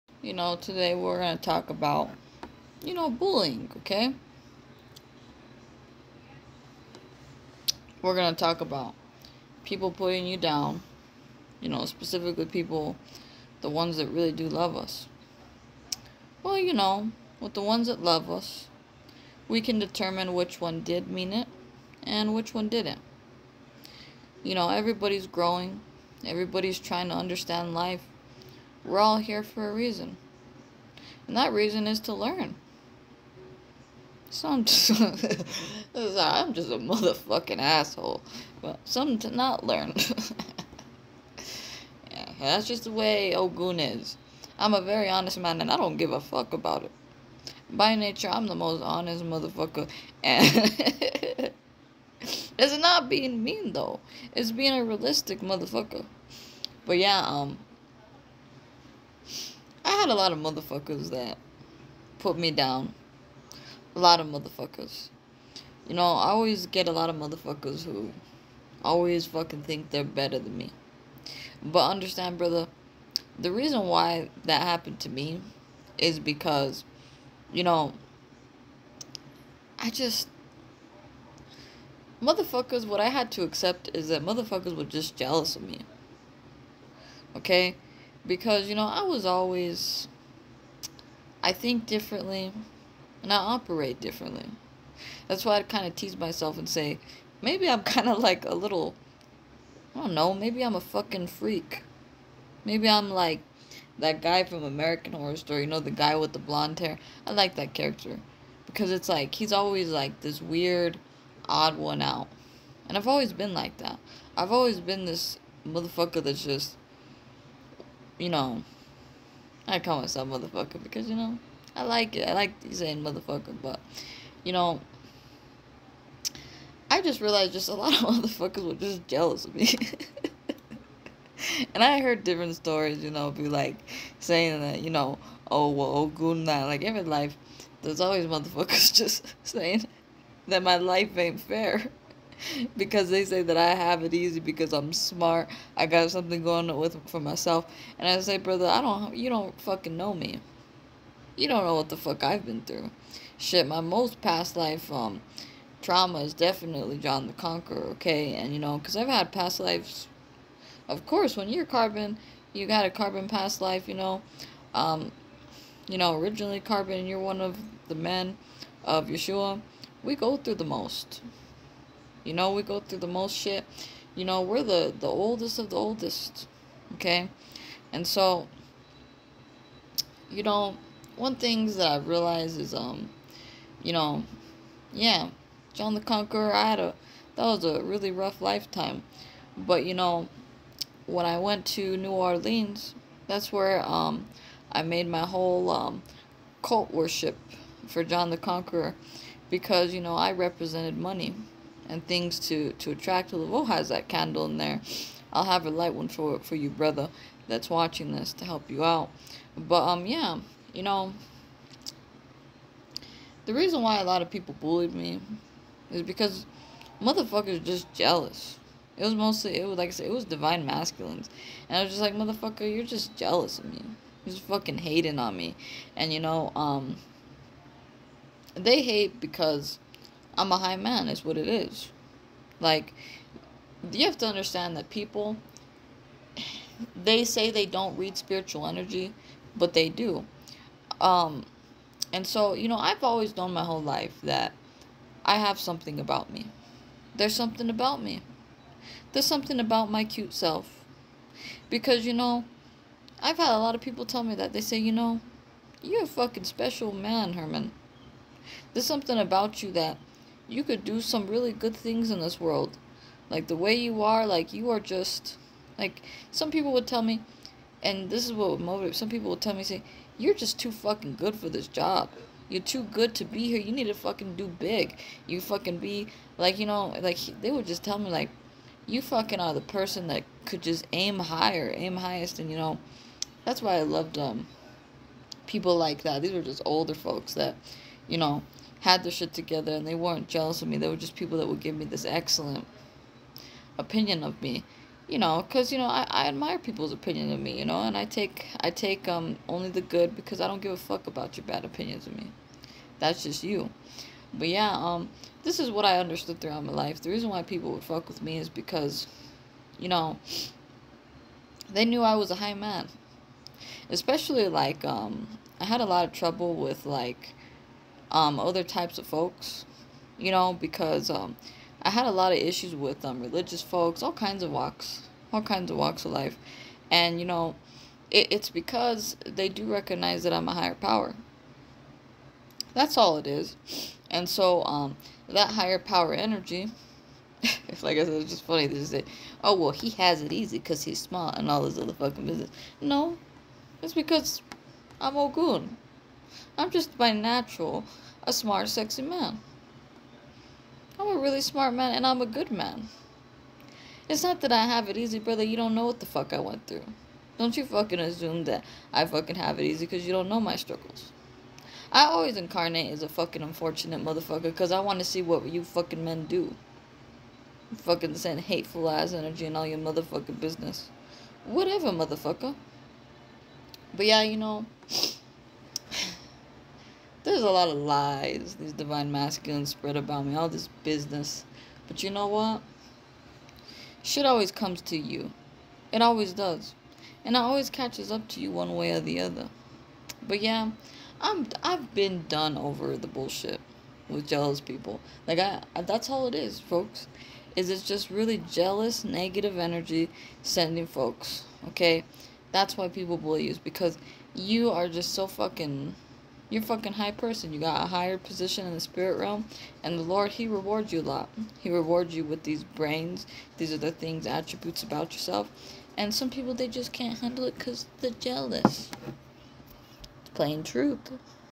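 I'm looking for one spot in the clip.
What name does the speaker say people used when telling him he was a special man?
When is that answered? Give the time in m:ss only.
4:17.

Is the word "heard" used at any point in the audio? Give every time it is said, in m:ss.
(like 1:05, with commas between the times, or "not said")
2:11.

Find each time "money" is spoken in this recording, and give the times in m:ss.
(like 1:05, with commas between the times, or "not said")
3:20.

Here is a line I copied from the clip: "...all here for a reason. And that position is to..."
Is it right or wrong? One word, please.
wrong.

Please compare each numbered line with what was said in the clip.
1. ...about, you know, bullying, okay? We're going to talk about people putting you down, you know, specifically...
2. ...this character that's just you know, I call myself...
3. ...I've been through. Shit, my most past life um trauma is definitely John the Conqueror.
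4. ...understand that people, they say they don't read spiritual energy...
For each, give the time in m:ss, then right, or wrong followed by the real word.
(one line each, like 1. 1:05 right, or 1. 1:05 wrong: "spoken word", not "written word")
1. 0:01 right
2. 1:55 wrong: "motherfucker", not "character"
3. 2:32 right
4. 3:54 right.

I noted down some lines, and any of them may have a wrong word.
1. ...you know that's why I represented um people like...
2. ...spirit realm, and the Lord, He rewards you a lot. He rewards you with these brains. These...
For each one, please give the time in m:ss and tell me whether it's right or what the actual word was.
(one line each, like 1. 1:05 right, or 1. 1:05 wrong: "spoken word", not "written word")
1. 4:42 wrong: "loved", not "represented"
2. 6:48 right.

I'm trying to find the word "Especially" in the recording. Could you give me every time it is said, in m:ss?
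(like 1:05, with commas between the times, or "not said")
5:13.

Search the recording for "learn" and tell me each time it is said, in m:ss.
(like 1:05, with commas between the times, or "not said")
0:32, 0:39.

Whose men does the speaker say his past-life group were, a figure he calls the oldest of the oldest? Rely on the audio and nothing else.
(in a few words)
Yeshua.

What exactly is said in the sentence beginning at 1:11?
But understand, brother, the reason why that happened to me is because, you know, I just.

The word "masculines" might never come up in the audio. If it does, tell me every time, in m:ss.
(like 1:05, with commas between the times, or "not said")
3:40, 6:19.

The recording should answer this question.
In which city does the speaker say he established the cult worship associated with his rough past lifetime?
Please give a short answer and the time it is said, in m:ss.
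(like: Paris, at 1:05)
New Orleans, at 3:11.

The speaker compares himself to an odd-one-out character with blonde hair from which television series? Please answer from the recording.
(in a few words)
American Horror Story.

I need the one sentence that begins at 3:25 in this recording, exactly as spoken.
I'll have a light one for, for you, brother, that's watching this to help you out.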